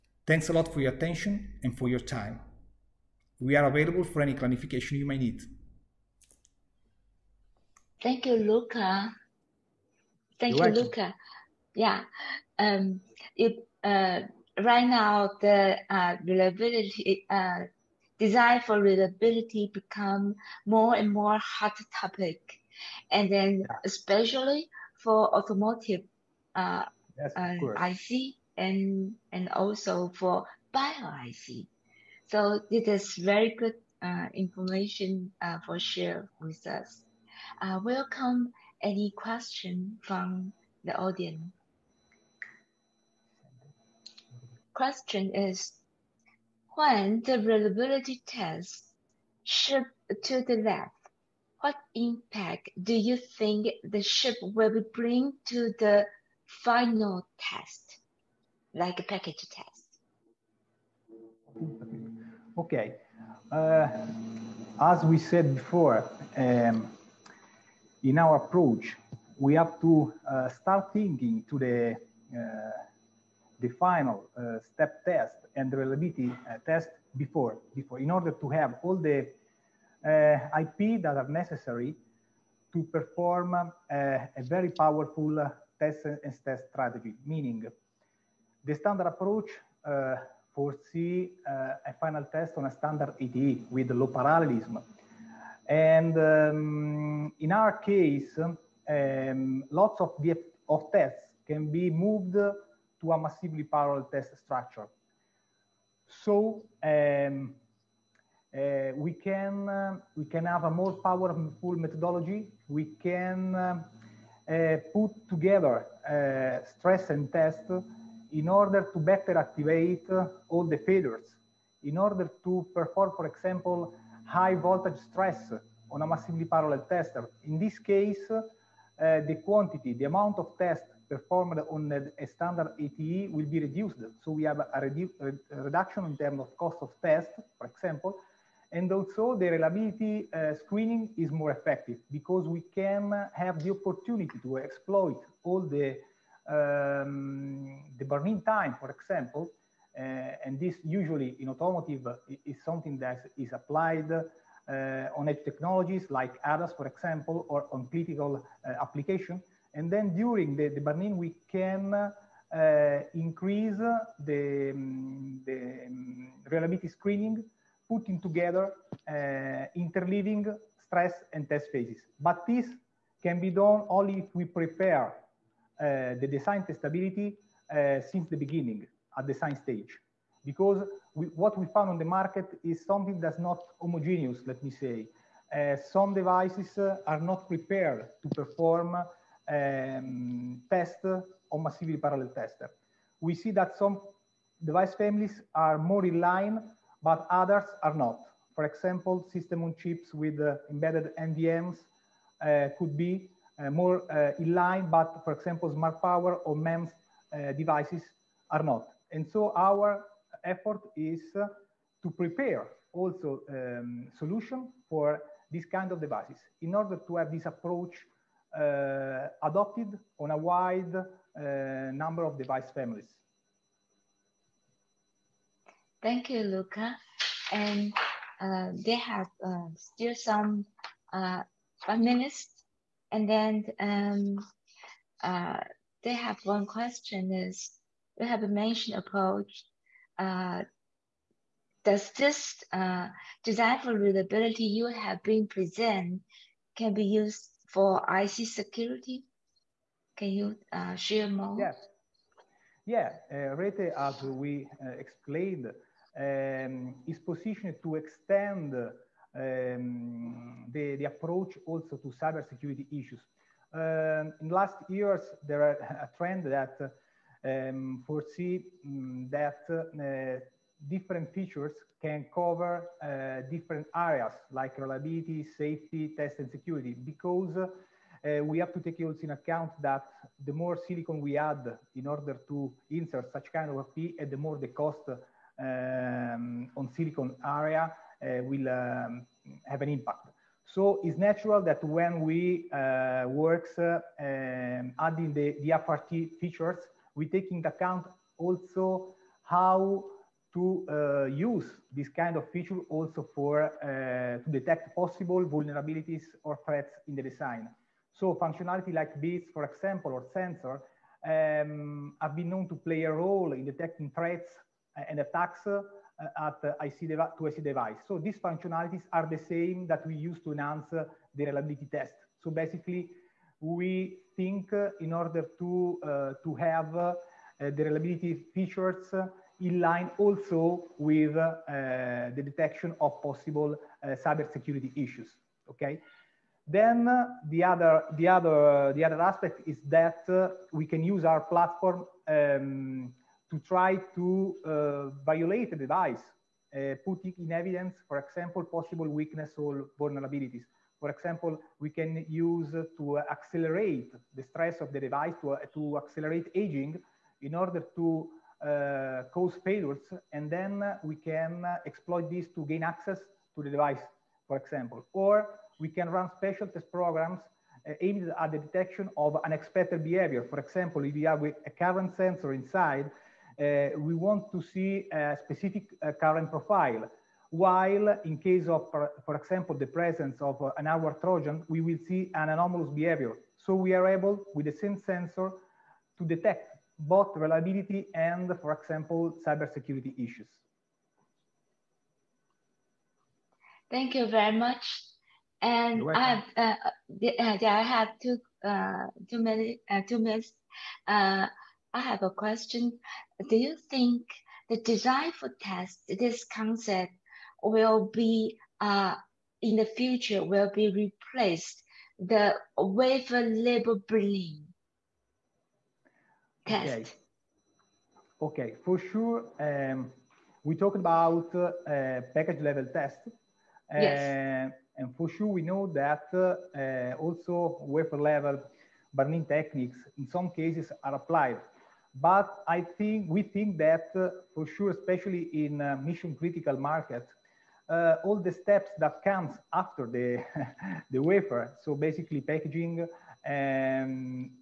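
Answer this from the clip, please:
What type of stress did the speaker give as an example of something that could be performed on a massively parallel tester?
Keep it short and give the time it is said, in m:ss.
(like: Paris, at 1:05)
high voltage stress, at 2:04.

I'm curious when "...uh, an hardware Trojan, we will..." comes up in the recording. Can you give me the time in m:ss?
6:20.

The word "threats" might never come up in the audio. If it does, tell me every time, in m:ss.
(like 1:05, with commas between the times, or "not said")
5:06, 5:14.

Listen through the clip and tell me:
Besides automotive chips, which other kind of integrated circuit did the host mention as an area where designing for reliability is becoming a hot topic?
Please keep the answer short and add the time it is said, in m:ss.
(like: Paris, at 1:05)
bio IC, at 0:30.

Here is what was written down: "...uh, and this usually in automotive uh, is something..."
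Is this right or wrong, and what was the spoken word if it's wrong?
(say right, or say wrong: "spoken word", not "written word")
right.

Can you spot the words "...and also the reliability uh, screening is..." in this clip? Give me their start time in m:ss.
2:18.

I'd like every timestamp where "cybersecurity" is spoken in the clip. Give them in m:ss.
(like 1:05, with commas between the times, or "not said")
4:22, 5:34, 6:29.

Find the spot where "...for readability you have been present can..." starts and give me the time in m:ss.
4:03.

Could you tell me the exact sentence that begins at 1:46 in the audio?
So um, uh, we can uh, we can have a more powerful methodology.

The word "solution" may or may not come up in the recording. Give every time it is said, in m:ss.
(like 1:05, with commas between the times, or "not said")
3:34.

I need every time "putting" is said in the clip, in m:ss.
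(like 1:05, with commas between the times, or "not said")
2:47, 5:47.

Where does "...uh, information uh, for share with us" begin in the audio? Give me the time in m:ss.
0:34.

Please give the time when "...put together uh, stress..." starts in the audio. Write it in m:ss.
1:54.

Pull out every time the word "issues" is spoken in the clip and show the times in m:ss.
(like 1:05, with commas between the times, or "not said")
4:22, 5:34, 6:30.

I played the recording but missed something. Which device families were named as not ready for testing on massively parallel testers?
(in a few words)
smart power or MEMS.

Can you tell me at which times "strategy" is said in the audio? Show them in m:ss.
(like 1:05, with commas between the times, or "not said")
1:26.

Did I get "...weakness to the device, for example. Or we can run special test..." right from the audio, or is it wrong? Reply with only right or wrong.
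wrong.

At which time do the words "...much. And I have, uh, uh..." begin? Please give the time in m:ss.
6:34.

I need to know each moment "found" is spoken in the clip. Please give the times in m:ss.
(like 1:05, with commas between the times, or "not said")
3:01.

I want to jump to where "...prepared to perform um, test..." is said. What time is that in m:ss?
3:07.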